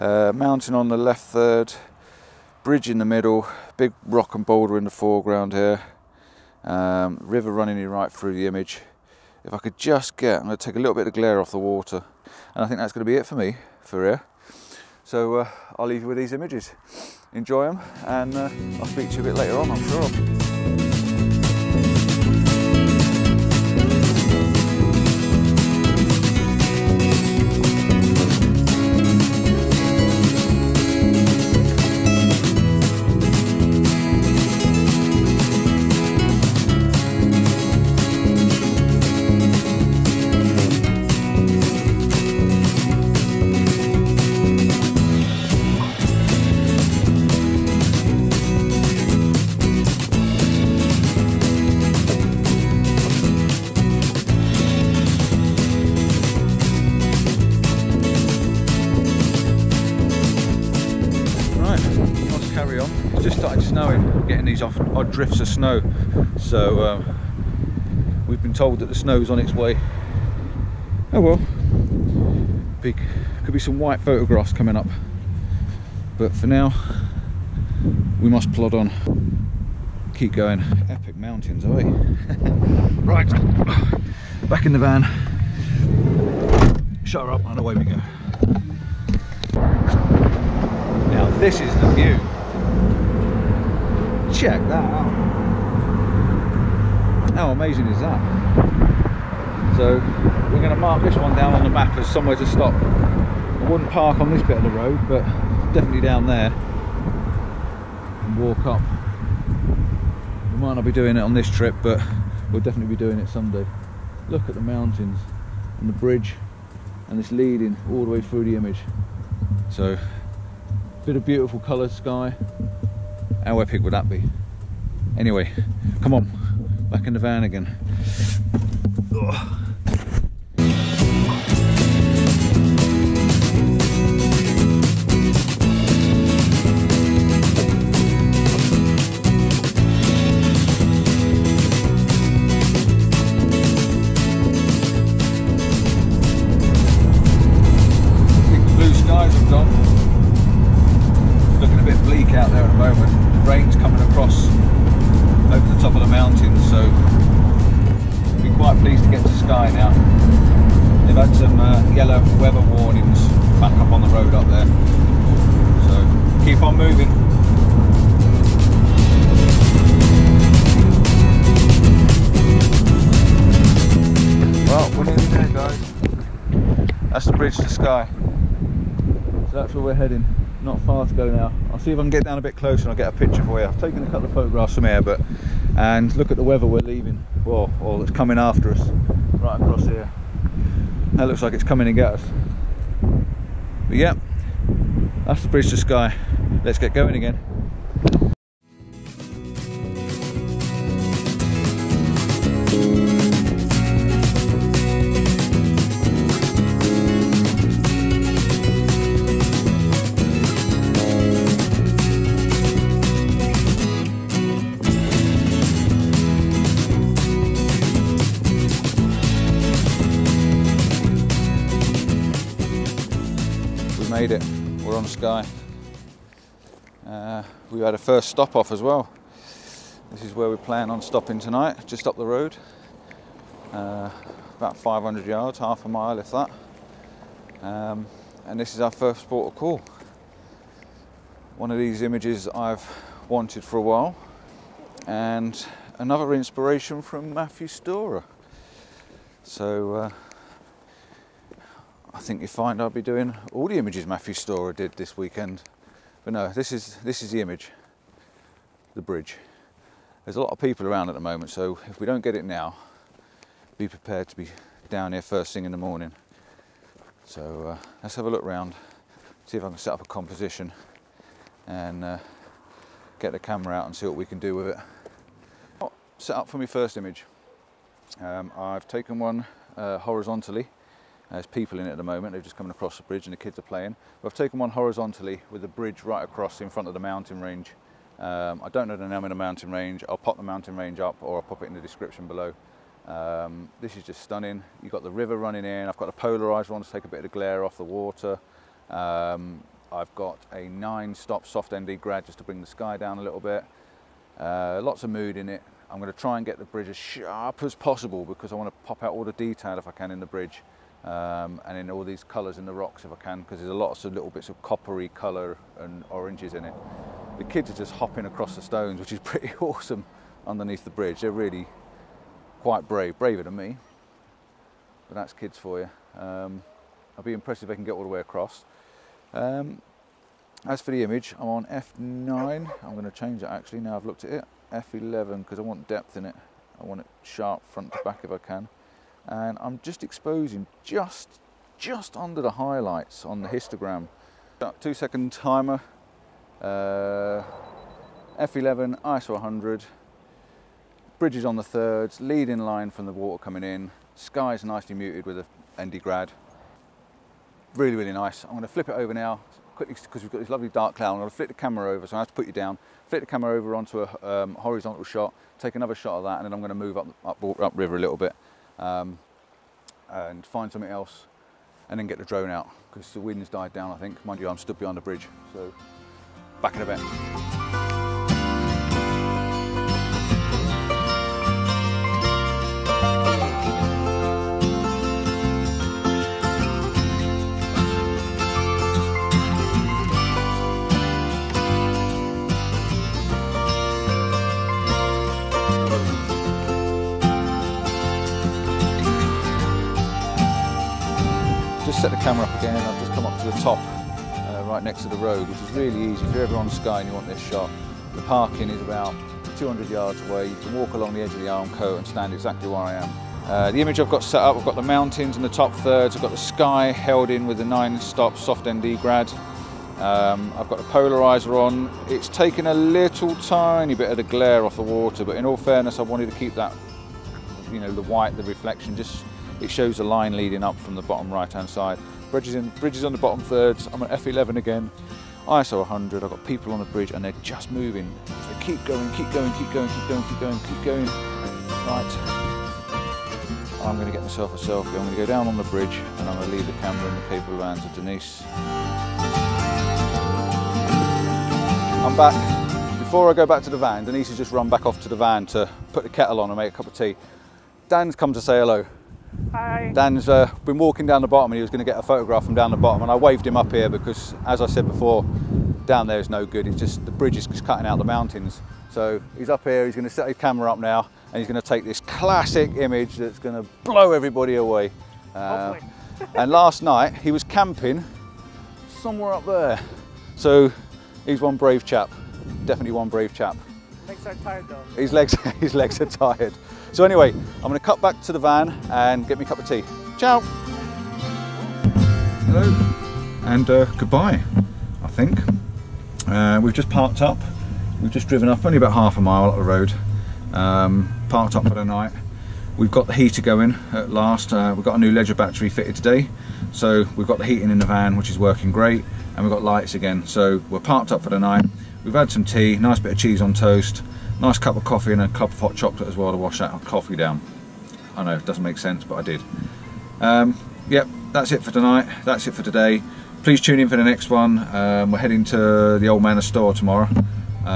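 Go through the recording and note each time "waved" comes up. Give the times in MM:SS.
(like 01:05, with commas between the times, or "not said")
07:43.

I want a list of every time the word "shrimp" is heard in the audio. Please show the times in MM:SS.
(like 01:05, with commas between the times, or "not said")
not said.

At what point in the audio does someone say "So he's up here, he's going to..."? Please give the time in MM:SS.
07:48.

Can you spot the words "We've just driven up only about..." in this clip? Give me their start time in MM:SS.
08:18.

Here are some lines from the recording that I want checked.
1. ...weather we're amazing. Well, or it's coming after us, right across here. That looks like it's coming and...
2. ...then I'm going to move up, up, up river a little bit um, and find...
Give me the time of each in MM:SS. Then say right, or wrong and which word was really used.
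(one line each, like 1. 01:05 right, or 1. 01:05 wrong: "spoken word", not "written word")
1. 03:06 wrong: "leaving", not "amazing"
2. 06:06 right.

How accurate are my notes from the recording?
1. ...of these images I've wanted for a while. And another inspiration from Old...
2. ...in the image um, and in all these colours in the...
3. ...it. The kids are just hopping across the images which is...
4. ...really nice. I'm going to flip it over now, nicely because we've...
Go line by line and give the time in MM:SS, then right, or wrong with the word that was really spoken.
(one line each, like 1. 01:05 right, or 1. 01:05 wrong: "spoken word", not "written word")
1. 04:01 wrong: "Matthew", not "Old"
2. 05:10 wrong: "bridge", not "image"
3. 05:16 wrong: "stones", not "images"
4. 05:57 wrong: "quickly", not "nicely".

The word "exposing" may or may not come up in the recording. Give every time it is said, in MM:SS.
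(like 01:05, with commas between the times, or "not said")
05:40.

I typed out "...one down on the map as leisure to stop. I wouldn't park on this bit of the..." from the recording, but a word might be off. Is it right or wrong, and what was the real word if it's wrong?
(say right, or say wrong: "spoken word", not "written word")
wrong: "somewhere", not "leisure".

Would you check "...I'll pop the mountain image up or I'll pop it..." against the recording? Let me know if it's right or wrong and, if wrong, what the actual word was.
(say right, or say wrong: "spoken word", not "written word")
wrong: "range", not "image".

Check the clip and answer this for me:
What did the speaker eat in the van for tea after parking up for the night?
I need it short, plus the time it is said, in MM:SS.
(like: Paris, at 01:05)
cheese on toast, at 08:33.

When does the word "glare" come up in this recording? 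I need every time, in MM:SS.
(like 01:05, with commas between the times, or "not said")
00:11, 04:57, 07:04.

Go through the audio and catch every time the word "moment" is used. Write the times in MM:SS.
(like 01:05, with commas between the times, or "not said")
04:21, 04:42.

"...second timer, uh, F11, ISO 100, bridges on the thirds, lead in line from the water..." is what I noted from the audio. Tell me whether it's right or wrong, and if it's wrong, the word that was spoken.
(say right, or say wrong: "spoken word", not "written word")
right.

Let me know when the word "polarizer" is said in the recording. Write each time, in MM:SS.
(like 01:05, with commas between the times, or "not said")
04:56, 07:00.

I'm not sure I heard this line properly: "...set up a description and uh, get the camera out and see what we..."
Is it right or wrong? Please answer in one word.
wrong.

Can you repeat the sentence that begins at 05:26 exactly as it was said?
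Um, I'll be impressed if they can get all the way across.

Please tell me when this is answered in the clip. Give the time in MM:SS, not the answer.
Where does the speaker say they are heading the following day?
08:46.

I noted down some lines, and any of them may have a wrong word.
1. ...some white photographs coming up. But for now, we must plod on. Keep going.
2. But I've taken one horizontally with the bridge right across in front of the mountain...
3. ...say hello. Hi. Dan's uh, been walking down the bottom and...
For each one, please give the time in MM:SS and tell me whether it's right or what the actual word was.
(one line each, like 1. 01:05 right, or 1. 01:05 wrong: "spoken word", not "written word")
1. 01:13 right
2. 04:44 right
3. 07:38 right.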